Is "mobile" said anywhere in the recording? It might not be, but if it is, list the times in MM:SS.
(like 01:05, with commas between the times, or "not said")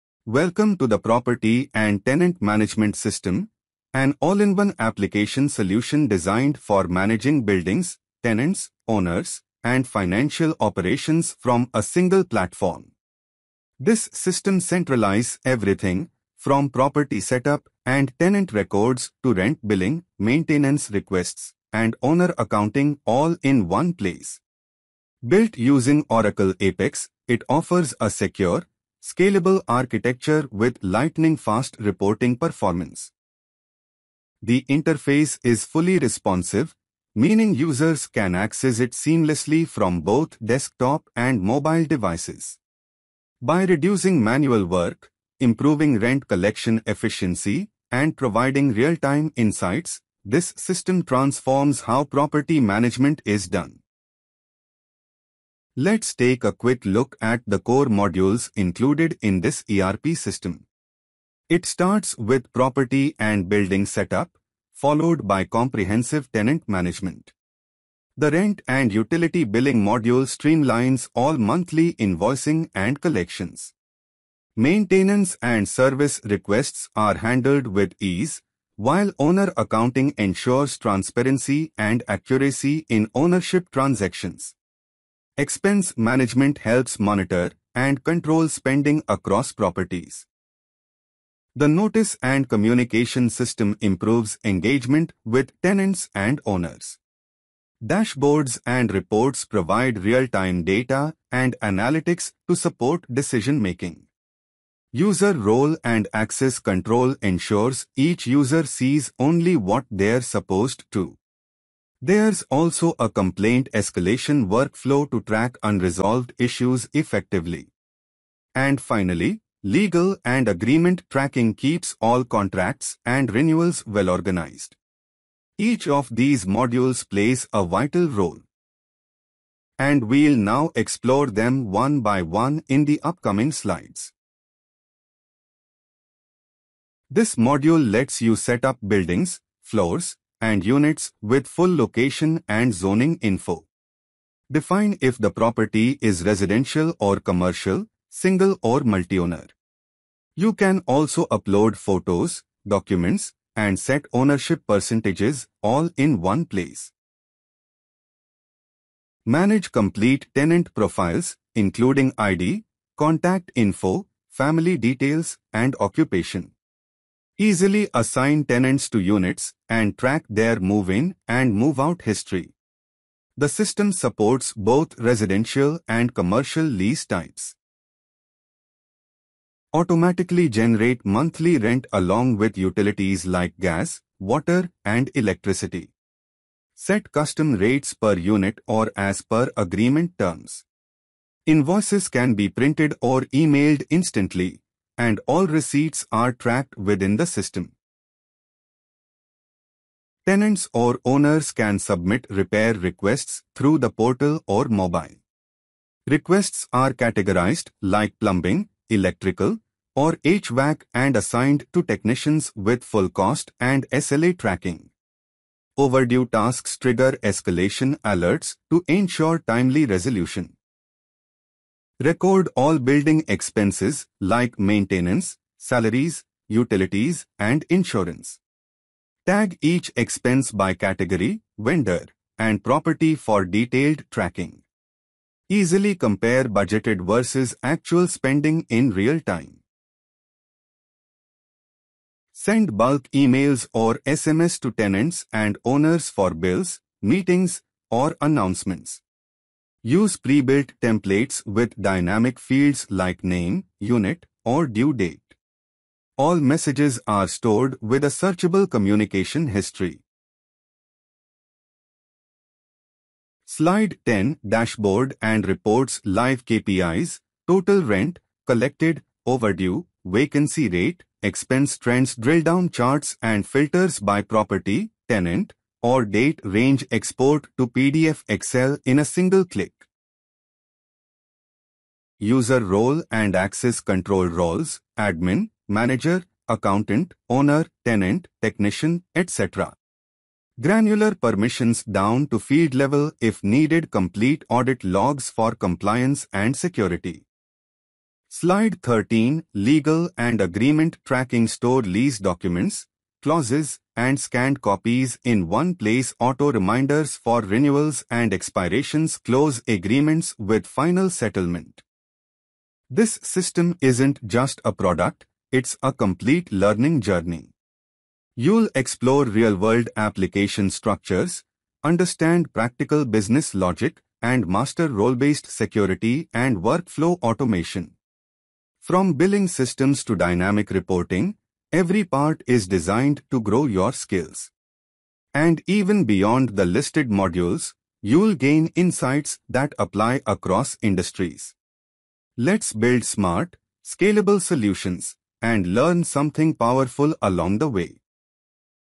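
00:41, 03:24.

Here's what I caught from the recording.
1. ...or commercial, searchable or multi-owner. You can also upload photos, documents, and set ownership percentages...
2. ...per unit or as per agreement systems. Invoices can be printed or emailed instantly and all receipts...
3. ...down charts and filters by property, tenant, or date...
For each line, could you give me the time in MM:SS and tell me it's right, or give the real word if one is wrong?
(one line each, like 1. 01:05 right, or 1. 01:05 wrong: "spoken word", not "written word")
1. 02:26 wrong: "single", not "searchable"
2. 03:07 wrong: "terms", not "systems"
3. 04:32 right.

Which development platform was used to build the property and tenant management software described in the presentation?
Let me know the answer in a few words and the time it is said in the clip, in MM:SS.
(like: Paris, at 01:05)
Oracle Apex, at 00:26.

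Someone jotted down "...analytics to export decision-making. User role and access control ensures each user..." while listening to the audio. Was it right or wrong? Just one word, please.
wrong.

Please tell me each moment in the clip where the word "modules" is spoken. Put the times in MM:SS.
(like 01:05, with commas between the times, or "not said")
00:57, 01:09, 02:06, 02:17, 05:37.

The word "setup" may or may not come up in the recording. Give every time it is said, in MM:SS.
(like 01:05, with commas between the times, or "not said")
00:17, 01:03.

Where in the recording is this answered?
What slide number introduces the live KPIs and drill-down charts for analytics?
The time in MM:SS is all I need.
04:23.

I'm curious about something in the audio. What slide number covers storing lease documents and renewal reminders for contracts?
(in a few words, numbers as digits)
13.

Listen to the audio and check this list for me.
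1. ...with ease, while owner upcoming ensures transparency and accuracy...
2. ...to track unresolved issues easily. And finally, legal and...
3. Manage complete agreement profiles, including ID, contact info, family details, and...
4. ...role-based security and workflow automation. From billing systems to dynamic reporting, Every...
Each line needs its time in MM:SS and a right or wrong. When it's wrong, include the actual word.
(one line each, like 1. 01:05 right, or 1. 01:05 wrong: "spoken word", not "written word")
1. 01:17 wrong: "accounting", not "upcoming"
2. 01:55 wrong: "effectively", not "easily"
3. 02:39 wrong: "tenant", not "agreement"
4. 05:24 right.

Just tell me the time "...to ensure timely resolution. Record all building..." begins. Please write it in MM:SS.
03:38.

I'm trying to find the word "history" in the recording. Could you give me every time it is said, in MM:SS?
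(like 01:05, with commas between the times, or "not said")
02:52, 04:19.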